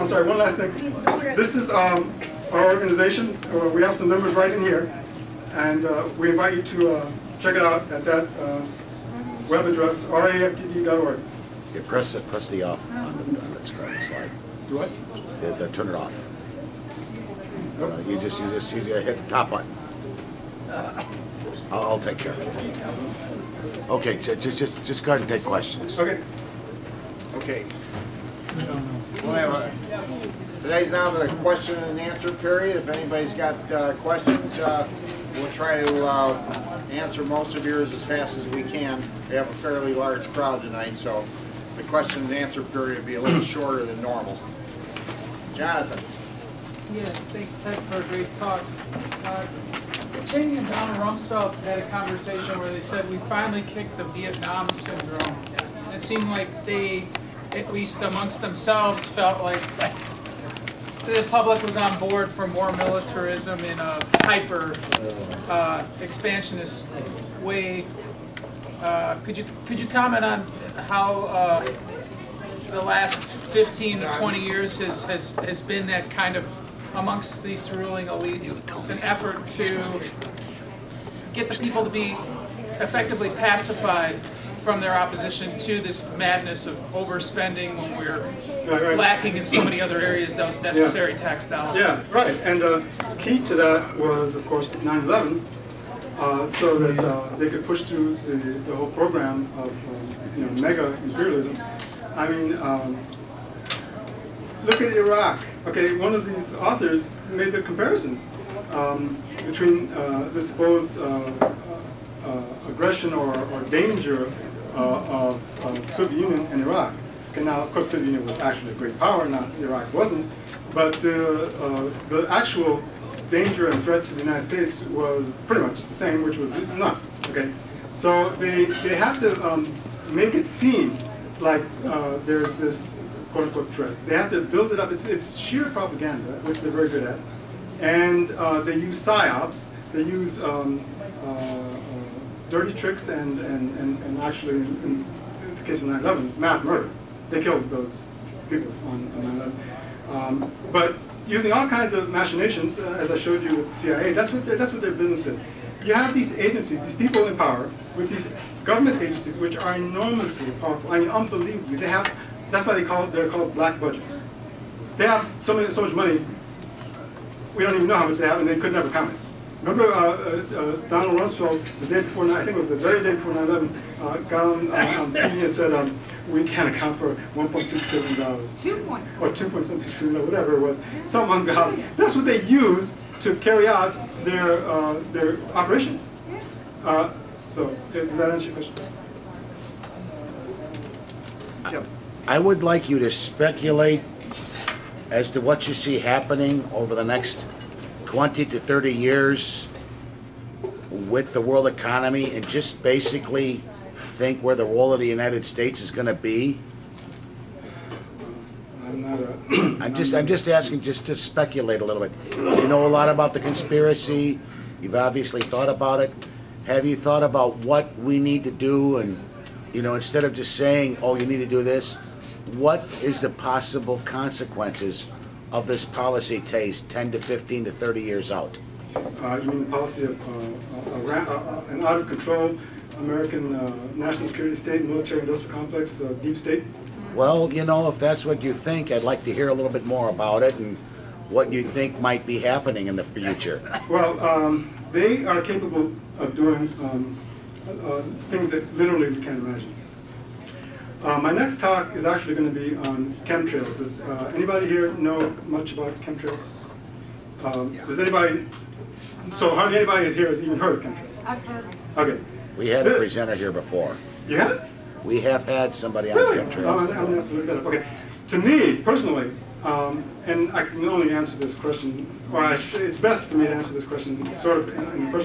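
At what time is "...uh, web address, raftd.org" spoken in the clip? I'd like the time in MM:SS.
00:08.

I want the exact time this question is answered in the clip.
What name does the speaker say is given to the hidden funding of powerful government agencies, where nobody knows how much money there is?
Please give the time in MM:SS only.
02:43.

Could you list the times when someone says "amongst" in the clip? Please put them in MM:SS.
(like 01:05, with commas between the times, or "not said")
00:58, 01:16.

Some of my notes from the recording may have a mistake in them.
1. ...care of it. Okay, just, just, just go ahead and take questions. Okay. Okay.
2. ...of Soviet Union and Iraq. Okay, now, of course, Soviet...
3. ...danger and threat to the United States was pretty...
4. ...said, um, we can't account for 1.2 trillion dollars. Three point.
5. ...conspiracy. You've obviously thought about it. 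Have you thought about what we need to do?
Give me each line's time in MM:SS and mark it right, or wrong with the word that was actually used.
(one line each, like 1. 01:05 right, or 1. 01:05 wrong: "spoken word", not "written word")
1. 00:22 right
2. 01:55 right
3. 02:03 right
4. 02:55 wrong: "Two", not "Three"
5. 03:33 right.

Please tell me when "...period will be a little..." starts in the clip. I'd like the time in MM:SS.
00:42.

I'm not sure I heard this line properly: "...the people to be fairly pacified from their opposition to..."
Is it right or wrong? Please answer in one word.
wrong.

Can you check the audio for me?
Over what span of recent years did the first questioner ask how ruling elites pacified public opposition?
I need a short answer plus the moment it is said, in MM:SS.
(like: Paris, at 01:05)
15 to 20 years, at 01:13.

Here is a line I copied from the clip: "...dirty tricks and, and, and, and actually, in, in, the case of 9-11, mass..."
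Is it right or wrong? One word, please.
right.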